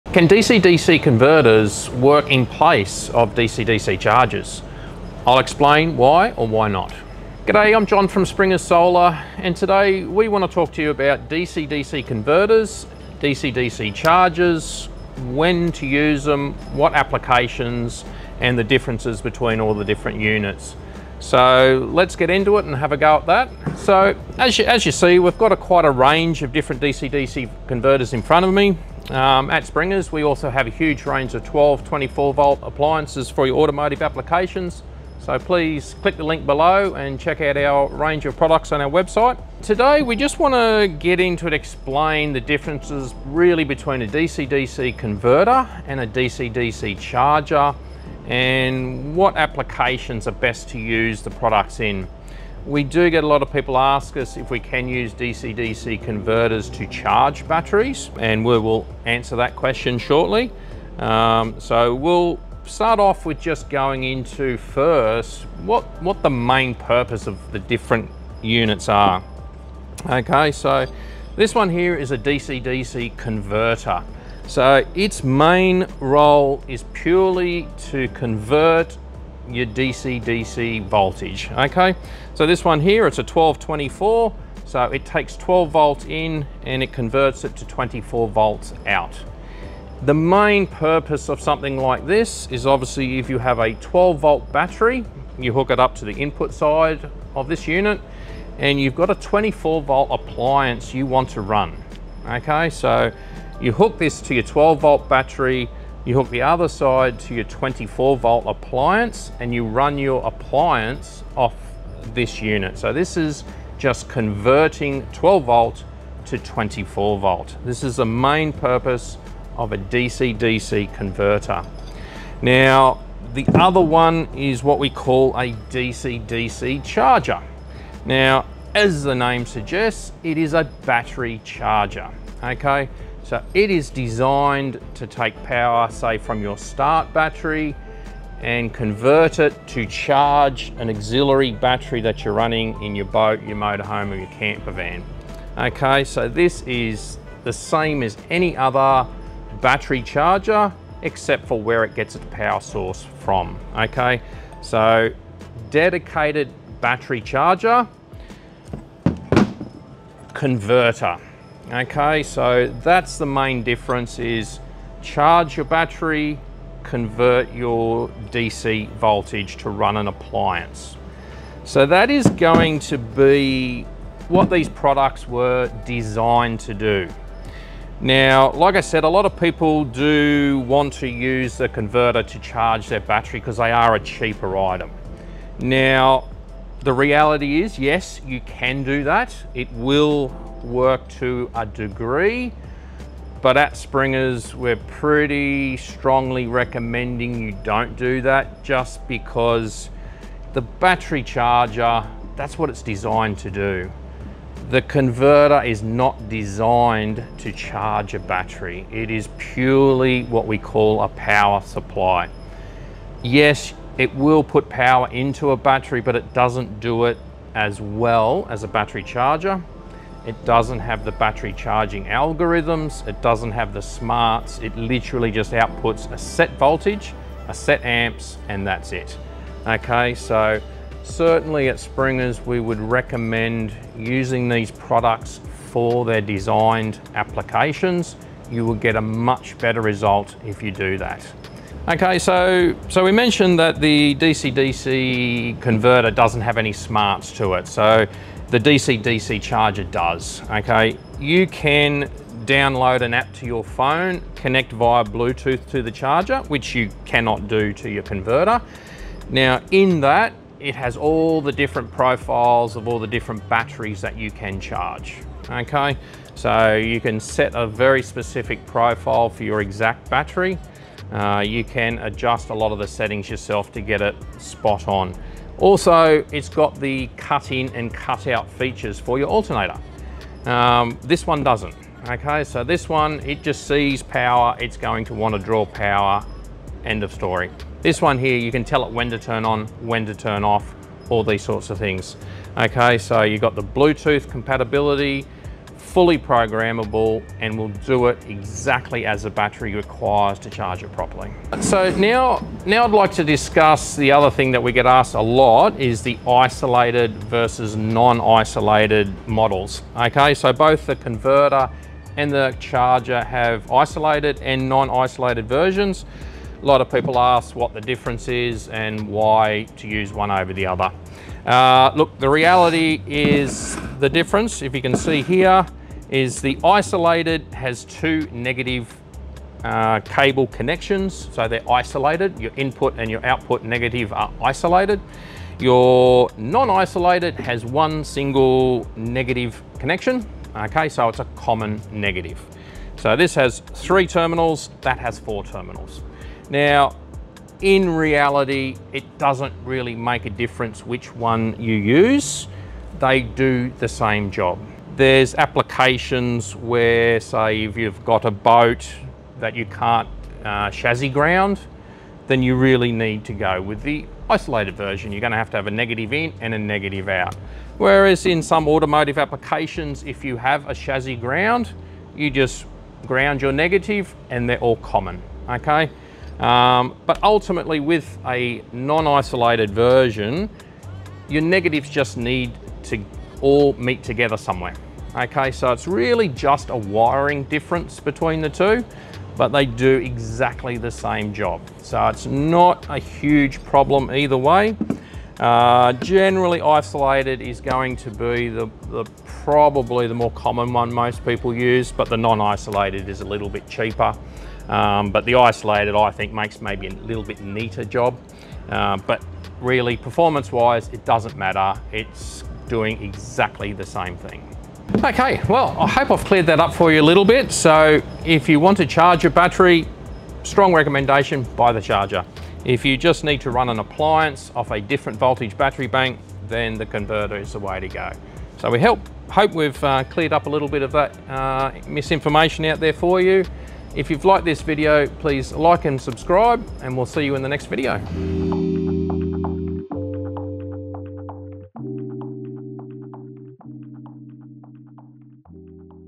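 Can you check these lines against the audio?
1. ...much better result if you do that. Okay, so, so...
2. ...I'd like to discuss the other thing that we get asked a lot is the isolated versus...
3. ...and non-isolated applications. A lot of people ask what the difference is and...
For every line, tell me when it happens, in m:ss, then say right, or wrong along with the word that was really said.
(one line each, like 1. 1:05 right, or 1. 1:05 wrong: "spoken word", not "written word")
1. 3:59 right
2. 5:02 right
3. 5:14 wrong: "versions", not "applications".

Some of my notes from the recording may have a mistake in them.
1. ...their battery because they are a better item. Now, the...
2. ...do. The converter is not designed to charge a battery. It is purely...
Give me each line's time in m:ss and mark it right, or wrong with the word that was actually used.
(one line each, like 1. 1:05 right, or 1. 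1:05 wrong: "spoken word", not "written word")
1. 3:02 wrong: "cheaper", not "better"
2. 3:23 right.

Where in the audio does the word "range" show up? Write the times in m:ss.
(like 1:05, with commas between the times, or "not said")
0:25, 0:31, 0:37.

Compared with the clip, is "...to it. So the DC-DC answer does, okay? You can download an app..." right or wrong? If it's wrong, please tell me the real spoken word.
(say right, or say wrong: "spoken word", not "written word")
wrong: "charger", not "answer".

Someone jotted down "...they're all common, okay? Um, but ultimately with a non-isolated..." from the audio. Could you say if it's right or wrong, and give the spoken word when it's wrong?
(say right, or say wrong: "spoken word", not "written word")
right.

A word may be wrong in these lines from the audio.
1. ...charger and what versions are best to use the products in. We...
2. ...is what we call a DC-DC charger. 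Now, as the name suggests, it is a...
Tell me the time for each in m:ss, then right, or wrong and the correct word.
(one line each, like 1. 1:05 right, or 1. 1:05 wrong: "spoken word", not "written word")
1. 0:46 wrong: "applications", not "versions"
2. 2:04 right.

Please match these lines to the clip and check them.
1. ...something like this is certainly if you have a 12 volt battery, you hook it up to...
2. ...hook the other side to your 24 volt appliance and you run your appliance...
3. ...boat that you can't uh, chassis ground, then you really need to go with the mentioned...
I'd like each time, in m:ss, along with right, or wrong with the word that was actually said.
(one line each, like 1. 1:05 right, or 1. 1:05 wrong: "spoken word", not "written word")
1. 1:31 wrong: "obviously", not "certainly"
2. 1:46 right
3. 5:58 wrong: "isolated", not "mentioned".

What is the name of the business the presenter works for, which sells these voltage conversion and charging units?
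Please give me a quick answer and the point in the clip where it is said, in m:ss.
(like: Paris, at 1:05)
Springers Solar, at 0:08.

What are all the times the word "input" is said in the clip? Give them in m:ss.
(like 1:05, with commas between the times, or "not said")
1:36, 5:32.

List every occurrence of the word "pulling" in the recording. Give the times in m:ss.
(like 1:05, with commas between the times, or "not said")
not said.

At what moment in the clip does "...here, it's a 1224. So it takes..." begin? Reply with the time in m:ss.
1:22.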